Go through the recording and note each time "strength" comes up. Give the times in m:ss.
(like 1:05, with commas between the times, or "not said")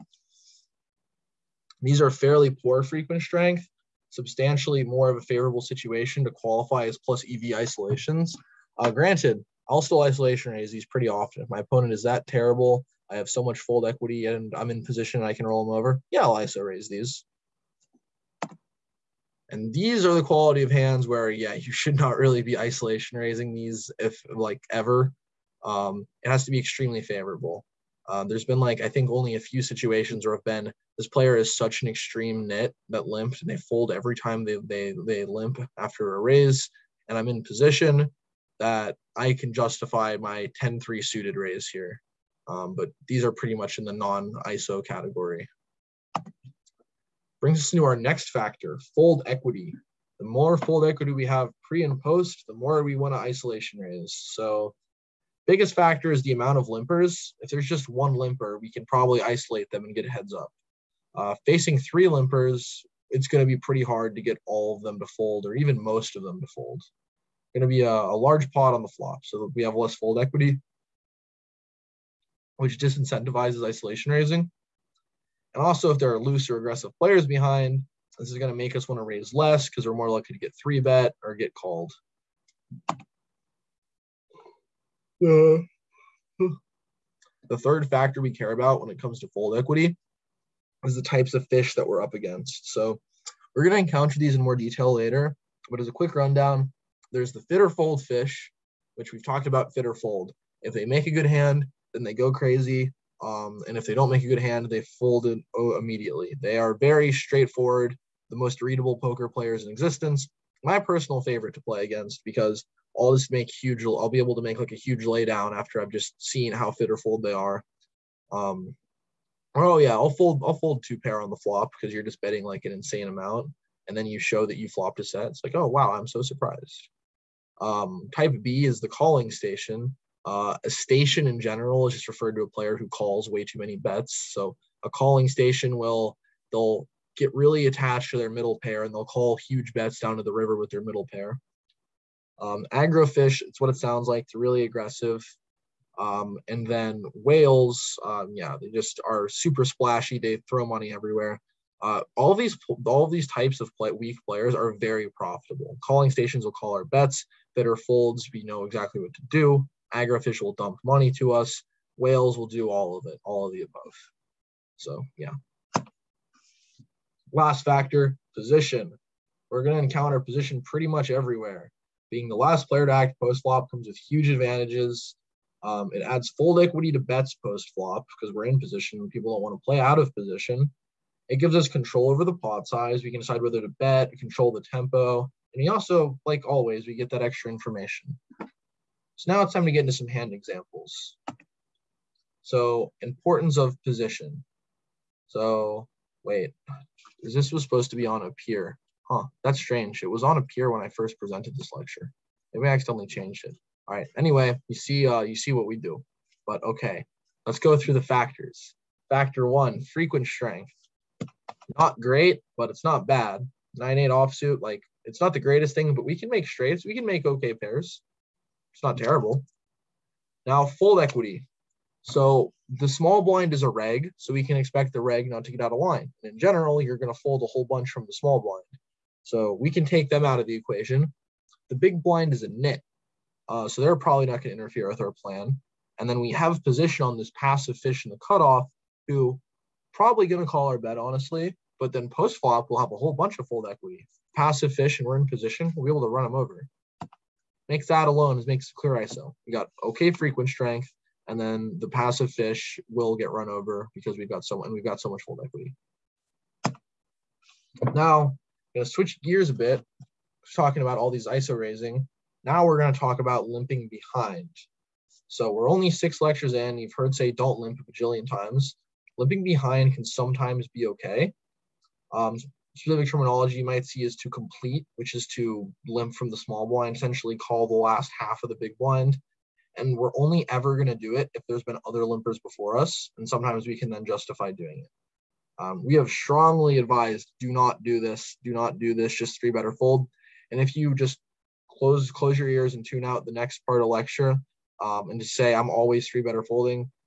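0:03, 3:30, 4:10.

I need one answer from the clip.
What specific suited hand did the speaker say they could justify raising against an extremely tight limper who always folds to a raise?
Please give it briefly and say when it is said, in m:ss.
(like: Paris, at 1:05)
10-3 suited, at 0:40.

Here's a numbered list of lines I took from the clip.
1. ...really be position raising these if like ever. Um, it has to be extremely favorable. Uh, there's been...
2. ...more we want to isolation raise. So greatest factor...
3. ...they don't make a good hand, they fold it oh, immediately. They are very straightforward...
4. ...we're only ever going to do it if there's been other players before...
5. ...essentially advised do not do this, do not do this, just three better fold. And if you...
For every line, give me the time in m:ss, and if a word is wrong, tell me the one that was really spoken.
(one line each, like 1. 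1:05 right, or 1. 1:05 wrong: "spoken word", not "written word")
1. 0:22 wrong: "isolation", not "position"
2. 0:52 wrong: "biggest", not "greatest"
3. 1:43 right
4. 4:39 wrong: "limpers", not "players"
5. 4:46 wrong: "strongly", not "essentially".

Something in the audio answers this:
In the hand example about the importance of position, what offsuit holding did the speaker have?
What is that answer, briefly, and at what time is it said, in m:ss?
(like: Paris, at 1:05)
9-8 offsuit, at 3:33.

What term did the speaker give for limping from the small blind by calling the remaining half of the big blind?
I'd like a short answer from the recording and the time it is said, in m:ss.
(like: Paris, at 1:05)
Complete, at 4:34.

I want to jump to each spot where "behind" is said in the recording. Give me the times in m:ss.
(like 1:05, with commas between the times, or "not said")
1:17, 4:23, 4:29.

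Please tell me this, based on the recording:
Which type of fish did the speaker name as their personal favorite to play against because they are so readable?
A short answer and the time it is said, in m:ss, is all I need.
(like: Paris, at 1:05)
Fit or fold fish, at 1:37.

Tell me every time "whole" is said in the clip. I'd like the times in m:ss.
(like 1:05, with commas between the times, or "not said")
3:47, 4:02.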